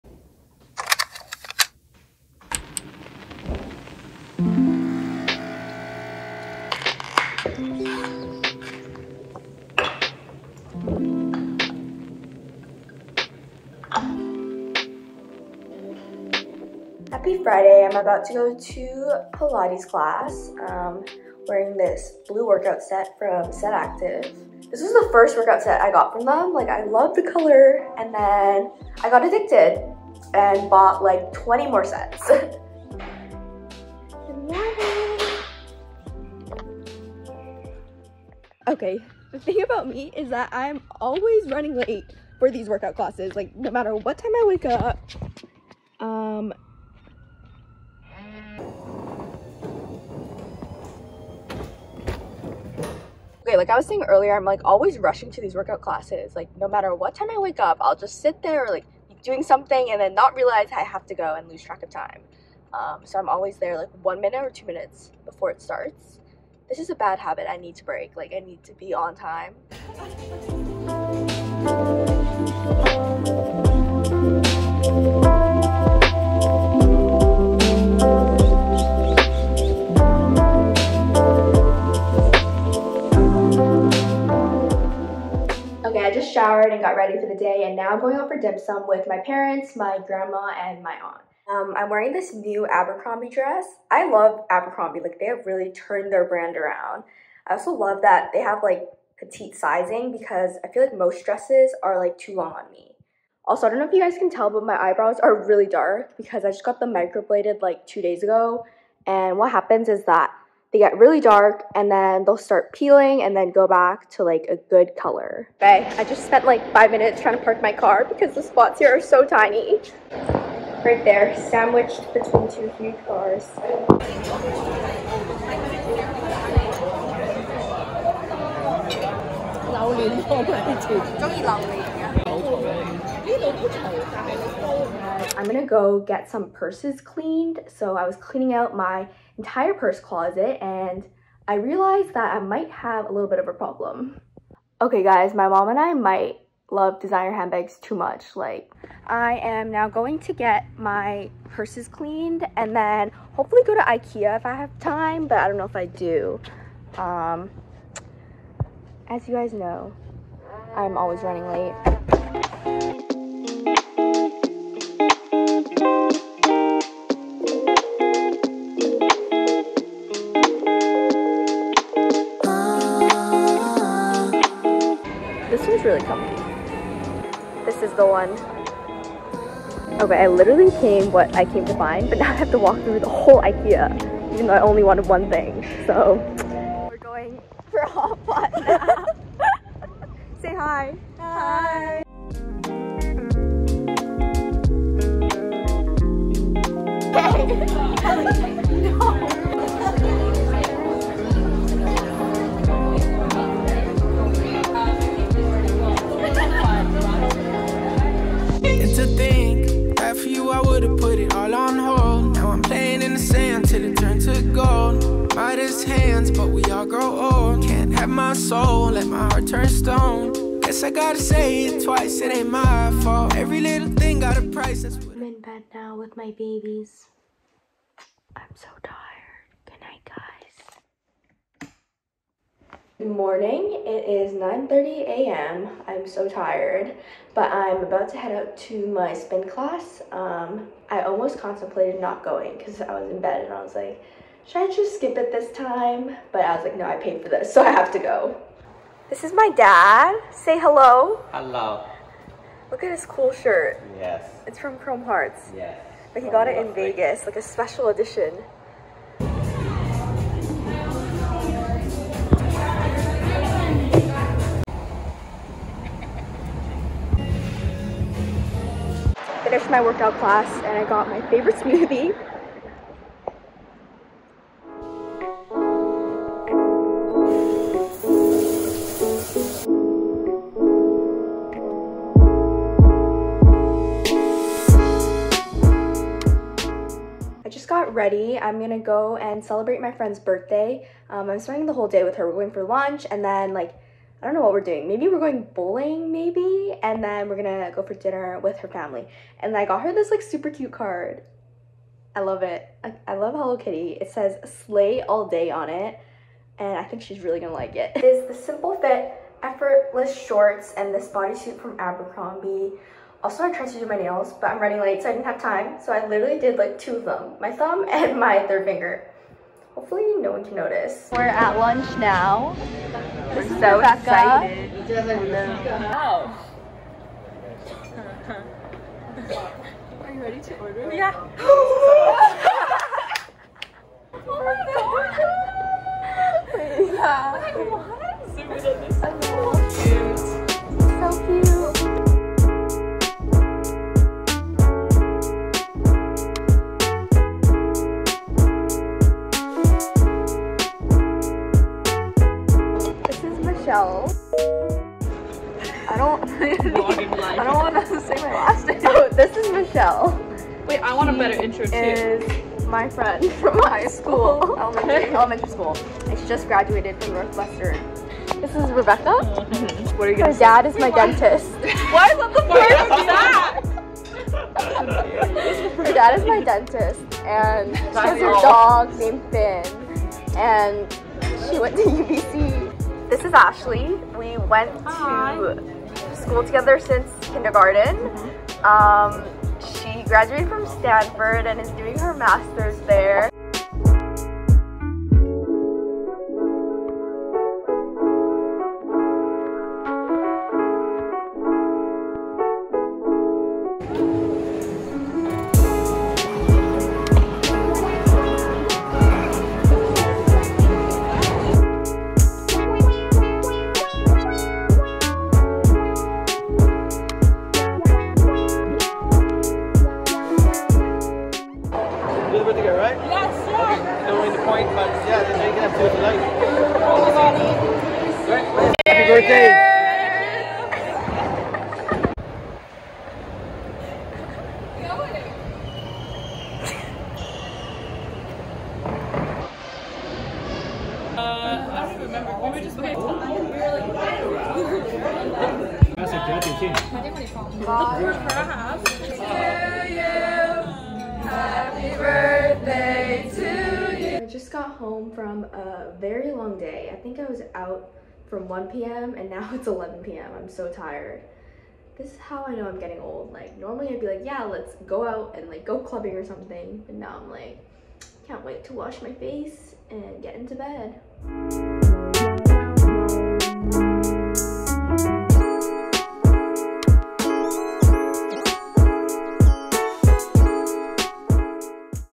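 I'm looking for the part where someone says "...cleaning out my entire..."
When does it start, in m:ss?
2:18.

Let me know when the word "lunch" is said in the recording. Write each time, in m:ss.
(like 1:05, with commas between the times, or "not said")
4:52, 5:21.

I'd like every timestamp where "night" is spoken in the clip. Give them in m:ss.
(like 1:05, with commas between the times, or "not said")
3:49.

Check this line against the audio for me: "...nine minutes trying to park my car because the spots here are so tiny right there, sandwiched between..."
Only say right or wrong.
wrong.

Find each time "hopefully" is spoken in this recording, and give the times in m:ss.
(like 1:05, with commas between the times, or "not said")
2:33, 5:19.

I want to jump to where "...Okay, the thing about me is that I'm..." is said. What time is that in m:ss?
0:38.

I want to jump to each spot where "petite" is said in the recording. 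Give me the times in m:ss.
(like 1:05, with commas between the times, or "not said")
1:39.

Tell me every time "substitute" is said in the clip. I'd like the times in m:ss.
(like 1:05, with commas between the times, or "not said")
not said.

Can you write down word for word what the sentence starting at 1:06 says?
This is a bad habit I need to break.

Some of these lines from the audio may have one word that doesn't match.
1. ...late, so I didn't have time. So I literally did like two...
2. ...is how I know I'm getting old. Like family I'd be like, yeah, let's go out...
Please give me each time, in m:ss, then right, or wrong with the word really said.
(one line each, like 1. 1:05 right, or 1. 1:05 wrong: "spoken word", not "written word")
1. 5:14 right
2. 7:42 wrong: "normally", not "family".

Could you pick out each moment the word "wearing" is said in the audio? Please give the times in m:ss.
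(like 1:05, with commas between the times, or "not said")
0:21, 1:31.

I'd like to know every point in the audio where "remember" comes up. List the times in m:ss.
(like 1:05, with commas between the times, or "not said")
7:22.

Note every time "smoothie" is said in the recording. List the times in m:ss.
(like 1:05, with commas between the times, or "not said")
4:31.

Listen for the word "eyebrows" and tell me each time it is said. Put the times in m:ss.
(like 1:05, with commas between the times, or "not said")
1:44.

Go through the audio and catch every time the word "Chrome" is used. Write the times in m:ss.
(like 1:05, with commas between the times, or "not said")
4:14.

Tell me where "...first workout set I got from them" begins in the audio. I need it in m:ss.
0:25.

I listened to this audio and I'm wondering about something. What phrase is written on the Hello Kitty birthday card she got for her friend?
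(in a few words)
Slay All Day.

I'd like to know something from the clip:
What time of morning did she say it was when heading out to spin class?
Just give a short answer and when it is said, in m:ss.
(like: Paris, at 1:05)
9:30 a.m., at 3:54.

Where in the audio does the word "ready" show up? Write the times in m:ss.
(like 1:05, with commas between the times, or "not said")
1:26, 4:47, 5:30.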